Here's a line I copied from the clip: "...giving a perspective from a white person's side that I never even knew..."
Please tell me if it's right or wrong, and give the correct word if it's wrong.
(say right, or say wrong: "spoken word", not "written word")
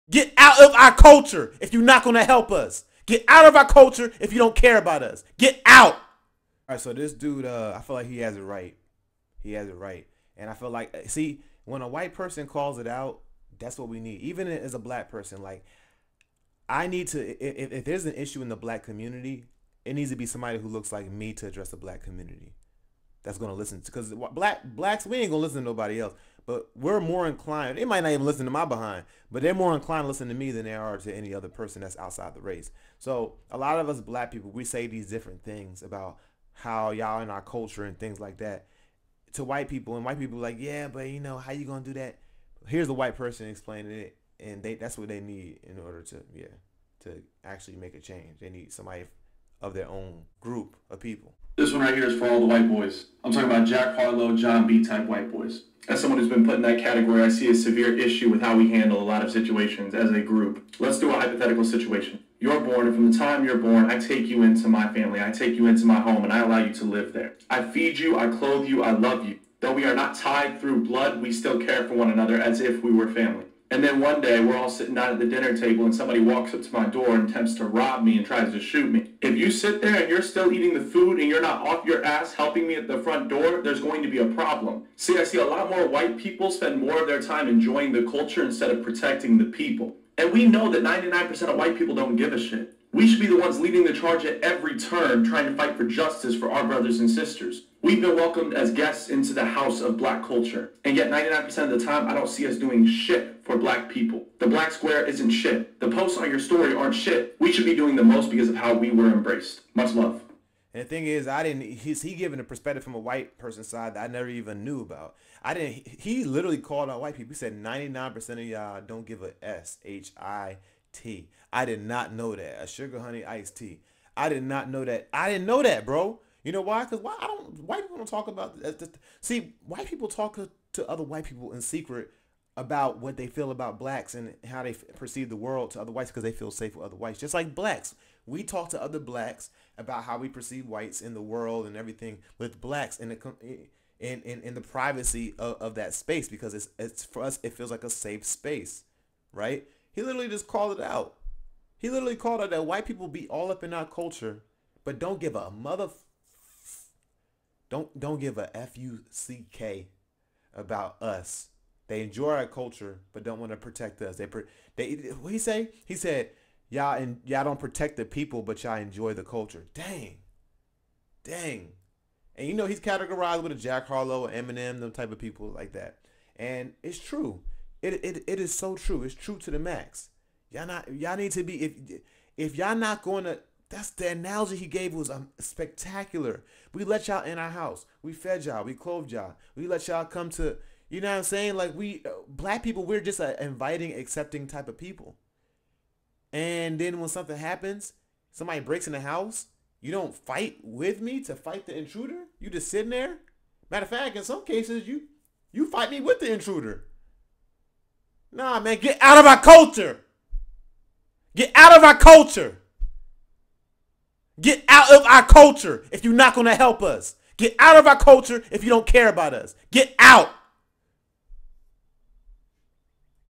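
right.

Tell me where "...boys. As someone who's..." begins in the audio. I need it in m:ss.
0:55.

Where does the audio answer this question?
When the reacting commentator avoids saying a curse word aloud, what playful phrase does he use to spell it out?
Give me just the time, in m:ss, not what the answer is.
2:02.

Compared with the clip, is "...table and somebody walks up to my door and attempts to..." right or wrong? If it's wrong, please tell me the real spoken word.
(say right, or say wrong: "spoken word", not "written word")
right.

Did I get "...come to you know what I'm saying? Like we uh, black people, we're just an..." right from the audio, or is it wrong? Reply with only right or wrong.
right.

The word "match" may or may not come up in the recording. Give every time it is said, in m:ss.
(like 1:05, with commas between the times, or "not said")
not said.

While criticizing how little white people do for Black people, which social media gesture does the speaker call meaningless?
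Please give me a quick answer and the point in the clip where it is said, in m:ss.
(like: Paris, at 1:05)
The black square, at 1:44.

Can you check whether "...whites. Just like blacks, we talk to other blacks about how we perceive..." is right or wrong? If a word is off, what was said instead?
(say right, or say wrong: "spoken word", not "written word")
right.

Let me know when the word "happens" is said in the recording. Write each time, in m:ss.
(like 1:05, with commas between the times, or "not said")
3:17.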